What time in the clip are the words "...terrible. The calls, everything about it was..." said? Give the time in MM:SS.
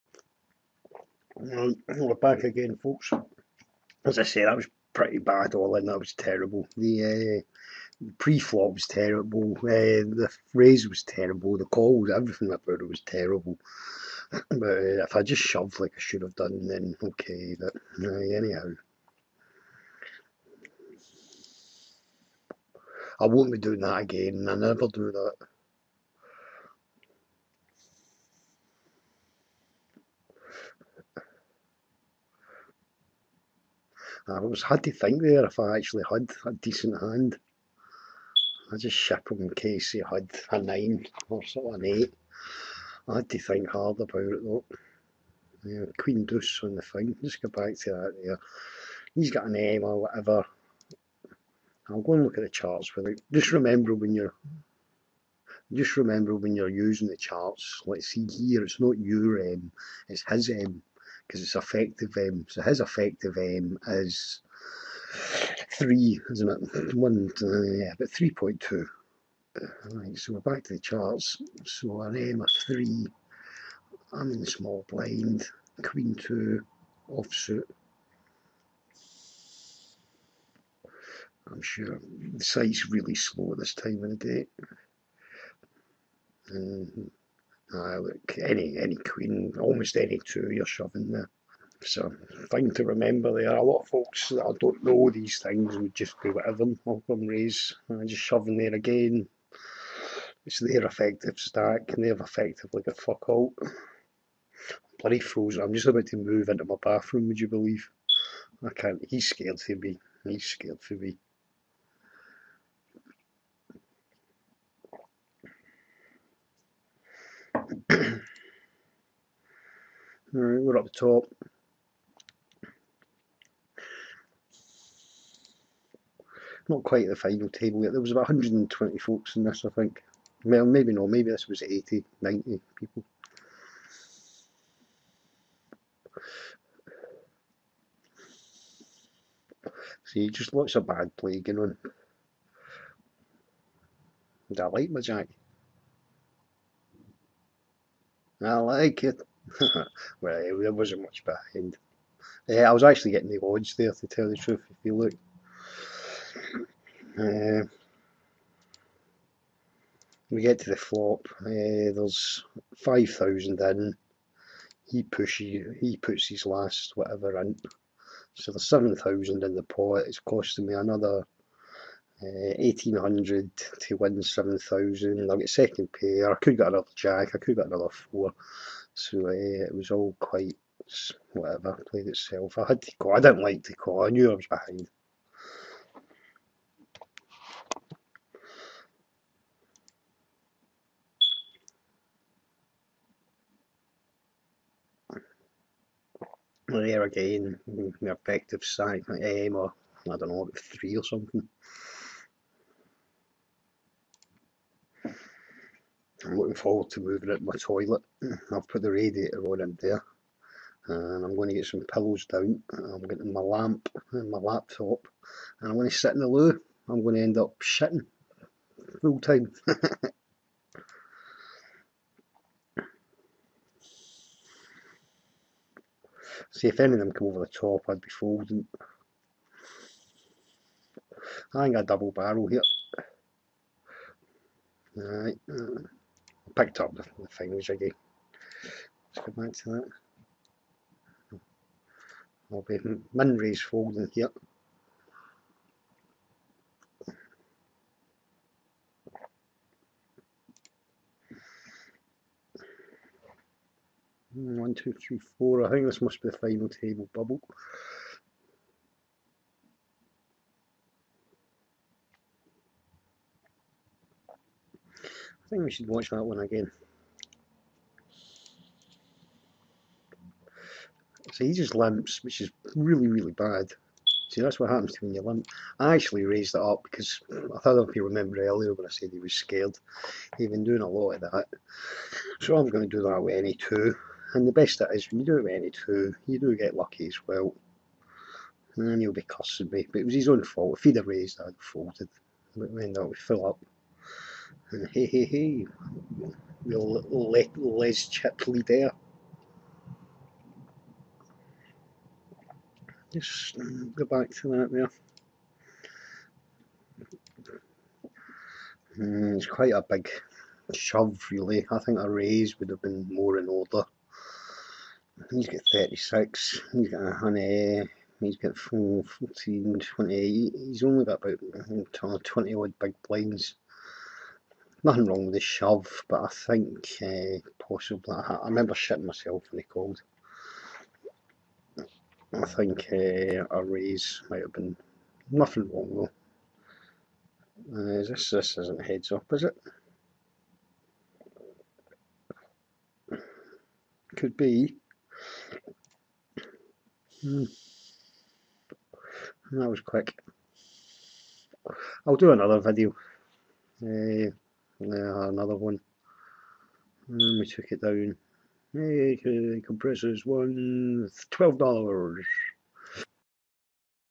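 00:11.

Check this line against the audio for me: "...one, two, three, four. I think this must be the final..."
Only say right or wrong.
right.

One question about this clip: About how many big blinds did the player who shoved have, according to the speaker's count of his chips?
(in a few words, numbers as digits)
20.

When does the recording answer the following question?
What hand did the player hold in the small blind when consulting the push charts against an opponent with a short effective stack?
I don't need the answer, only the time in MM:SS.
01:15.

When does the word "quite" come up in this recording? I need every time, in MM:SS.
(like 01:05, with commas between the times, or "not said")
02:06, 03:00, 05:09.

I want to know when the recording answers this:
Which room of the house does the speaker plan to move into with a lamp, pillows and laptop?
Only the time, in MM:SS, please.
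03:27.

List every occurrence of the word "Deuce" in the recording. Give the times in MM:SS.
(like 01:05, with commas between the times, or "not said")
00:46.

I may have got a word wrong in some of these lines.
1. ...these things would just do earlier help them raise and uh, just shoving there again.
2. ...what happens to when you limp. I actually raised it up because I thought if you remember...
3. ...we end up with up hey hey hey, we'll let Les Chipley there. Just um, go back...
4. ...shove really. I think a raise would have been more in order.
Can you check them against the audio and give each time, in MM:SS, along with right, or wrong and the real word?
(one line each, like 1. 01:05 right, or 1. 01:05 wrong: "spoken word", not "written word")
1. 01:35 wrong: "whatever", not "earlier"
2. 04:34 right
3. 04:52 right
4. 05:10 right.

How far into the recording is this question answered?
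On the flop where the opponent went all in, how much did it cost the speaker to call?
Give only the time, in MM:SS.
02:52.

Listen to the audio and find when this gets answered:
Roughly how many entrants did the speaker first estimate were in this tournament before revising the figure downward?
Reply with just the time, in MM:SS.
02:08.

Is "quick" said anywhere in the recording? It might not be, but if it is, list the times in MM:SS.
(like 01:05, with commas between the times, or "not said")
05:49.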